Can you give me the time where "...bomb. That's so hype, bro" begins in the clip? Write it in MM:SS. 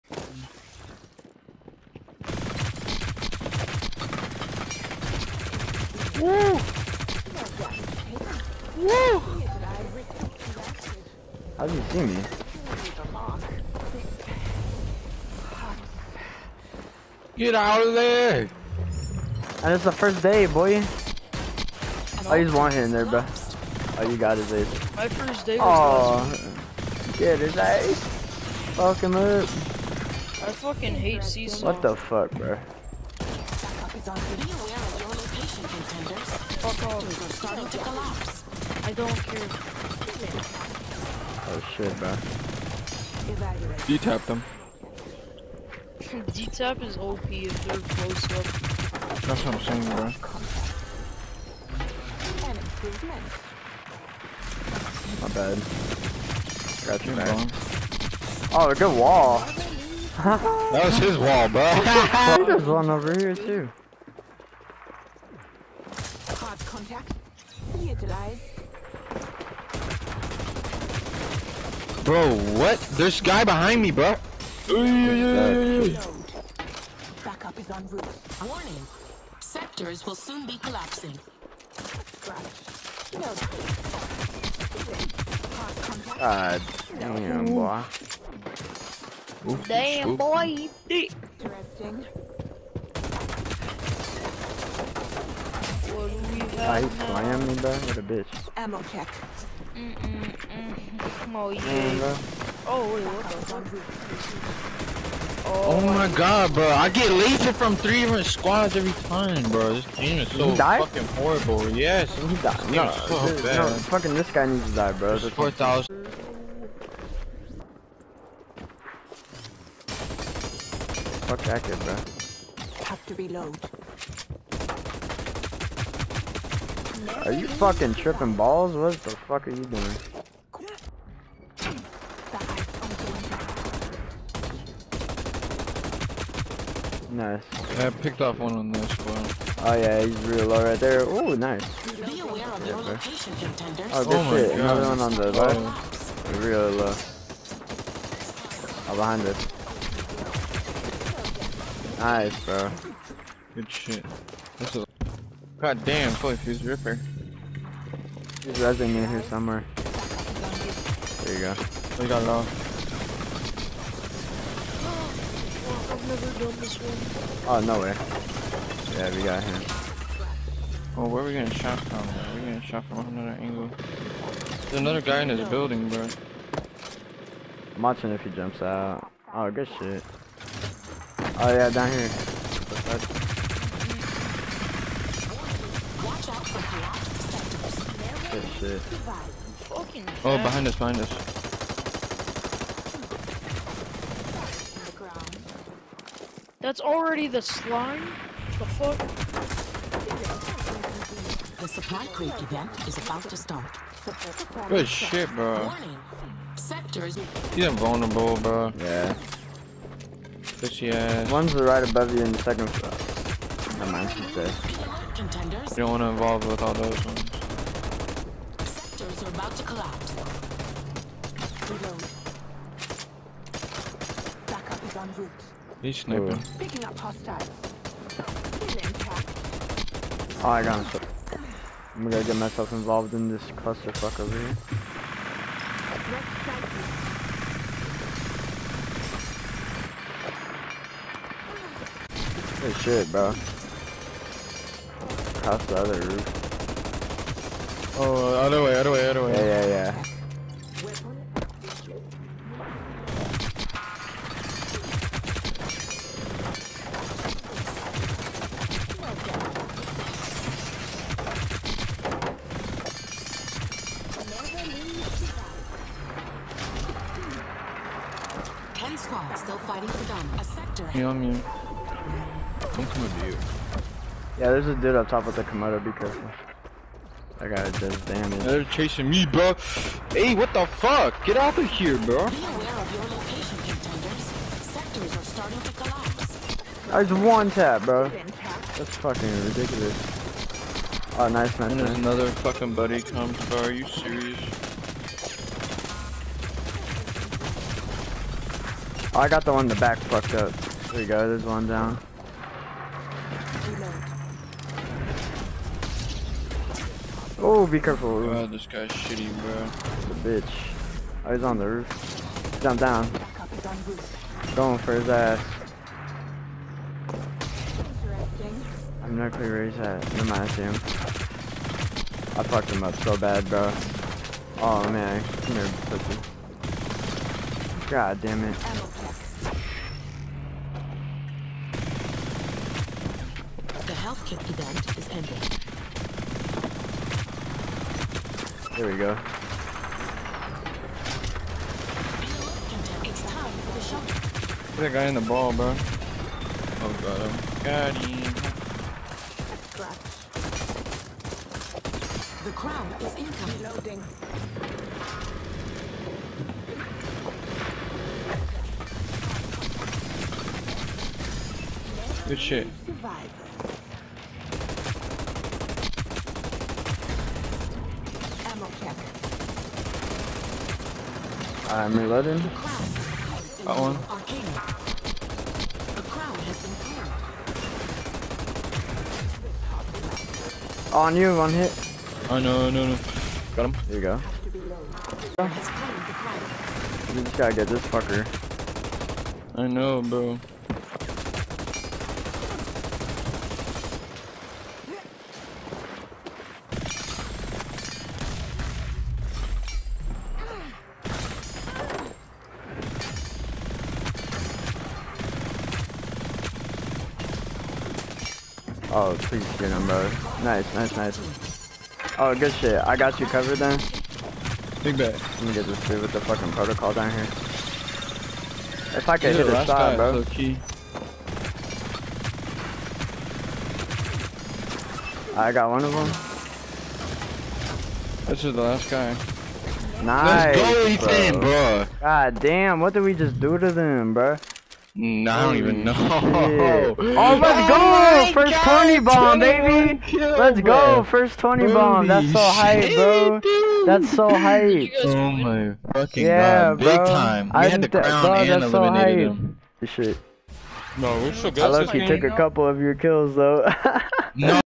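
07:21.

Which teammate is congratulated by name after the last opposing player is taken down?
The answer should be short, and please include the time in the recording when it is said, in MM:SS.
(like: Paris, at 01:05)
Ethan, at 07:10.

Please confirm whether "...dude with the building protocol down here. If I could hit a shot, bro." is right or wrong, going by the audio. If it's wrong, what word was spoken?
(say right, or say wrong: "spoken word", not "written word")
wrong: "fucking", not "building".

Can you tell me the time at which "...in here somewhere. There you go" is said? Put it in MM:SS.
02:38.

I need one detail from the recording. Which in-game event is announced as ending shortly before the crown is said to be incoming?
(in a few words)
Health kit event.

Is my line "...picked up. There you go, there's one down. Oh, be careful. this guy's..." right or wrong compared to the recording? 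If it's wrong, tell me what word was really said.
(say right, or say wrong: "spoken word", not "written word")
wrong: "fucked", not "picked".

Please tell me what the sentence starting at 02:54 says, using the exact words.
There's another guy in his building, bro.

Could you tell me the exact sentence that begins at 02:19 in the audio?
Oh yeah, he's real low right there.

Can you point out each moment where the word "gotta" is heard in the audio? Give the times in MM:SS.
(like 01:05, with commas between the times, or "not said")
04:37, 06:27.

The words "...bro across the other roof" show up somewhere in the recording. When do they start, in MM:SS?
04:03.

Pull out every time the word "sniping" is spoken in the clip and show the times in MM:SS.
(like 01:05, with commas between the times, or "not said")
03:45.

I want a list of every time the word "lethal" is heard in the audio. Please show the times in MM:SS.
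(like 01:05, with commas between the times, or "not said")
01:47.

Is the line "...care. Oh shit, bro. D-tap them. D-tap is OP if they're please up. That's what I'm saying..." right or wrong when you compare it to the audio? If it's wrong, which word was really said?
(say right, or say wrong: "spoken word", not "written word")
wrong: "close", not "please".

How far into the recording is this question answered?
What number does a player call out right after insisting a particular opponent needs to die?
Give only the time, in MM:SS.
01:55.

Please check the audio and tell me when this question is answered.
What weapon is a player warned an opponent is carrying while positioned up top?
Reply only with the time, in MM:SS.
04:34.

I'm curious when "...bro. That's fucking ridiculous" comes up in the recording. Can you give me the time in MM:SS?
04:47.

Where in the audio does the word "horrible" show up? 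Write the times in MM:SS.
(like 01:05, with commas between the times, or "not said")
01:51.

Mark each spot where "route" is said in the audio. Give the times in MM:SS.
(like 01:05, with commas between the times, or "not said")
01:17, 03:45.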